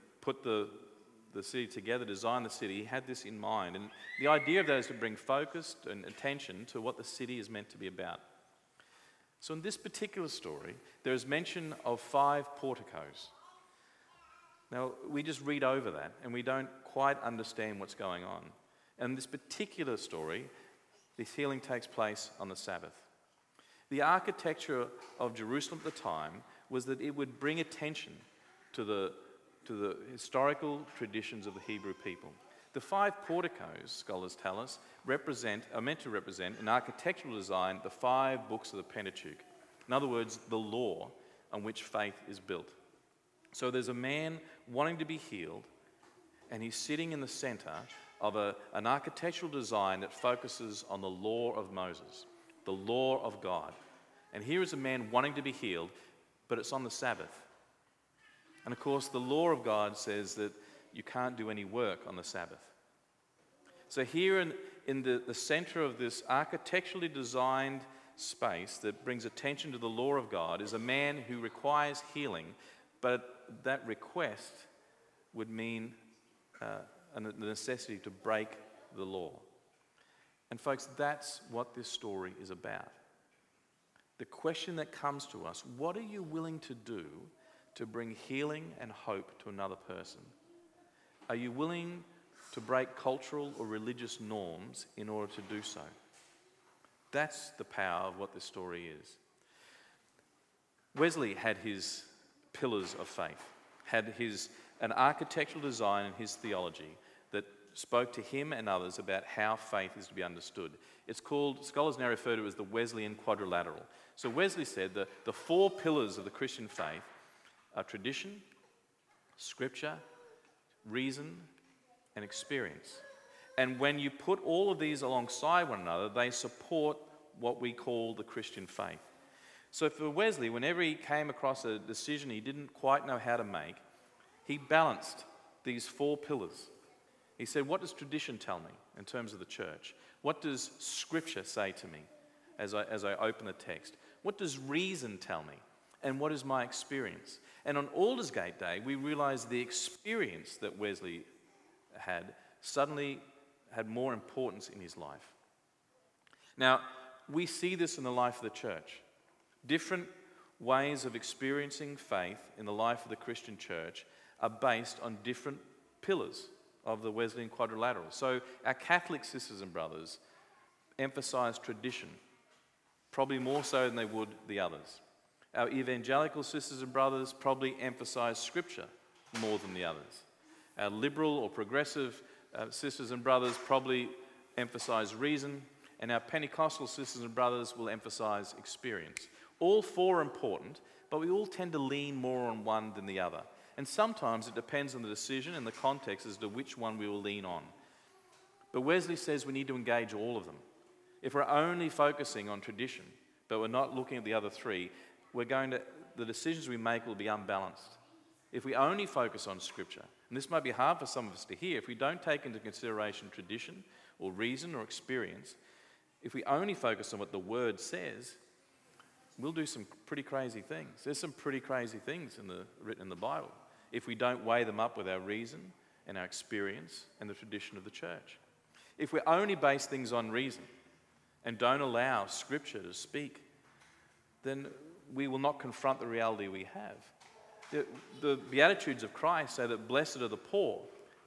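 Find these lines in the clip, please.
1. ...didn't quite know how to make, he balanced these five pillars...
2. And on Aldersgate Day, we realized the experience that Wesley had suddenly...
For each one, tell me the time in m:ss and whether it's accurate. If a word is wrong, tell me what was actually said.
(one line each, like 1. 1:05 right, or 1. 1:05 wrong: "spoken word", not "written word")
1. 2:12 wrong: "four", not "five"
2. 2:27 right.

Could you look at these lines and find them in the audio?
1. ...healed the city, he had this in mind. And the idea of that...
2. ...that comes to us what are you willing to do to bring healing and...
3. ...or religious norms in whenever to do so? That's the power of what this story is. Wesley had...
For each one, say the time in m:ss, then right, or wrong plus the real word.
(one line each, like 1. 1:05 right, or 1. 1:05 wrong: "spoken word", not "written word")
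1. 0:02 wrong: "designed", not "healed"
2. 1:24 right
3. 1:33 wrong: "order", not "whenever".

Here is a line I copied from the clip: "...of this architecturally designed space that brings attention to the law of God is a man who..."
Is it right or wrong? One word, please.
right.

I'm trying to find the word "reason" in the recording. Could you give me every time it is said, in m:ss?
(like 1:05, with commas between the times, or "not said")
2:00, 2:24, 3:05, 3:34, 3:45, 3:50.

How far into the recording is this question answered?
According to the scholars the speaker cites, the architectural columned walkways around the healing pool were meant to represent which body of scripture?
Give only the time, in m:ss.
0:37.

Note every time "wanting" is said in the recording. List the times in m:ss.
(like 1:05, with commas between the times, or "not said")
0:44, 0:55.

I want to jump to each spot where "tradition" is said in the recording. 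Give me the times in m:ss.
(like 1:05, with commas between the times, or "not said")
0:30, 1:57, 2:17, 2:51, 3:22, 3:33, 3:47.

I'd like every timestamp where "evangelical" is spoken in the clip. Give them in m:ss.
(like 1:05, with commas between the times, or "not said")
2:55.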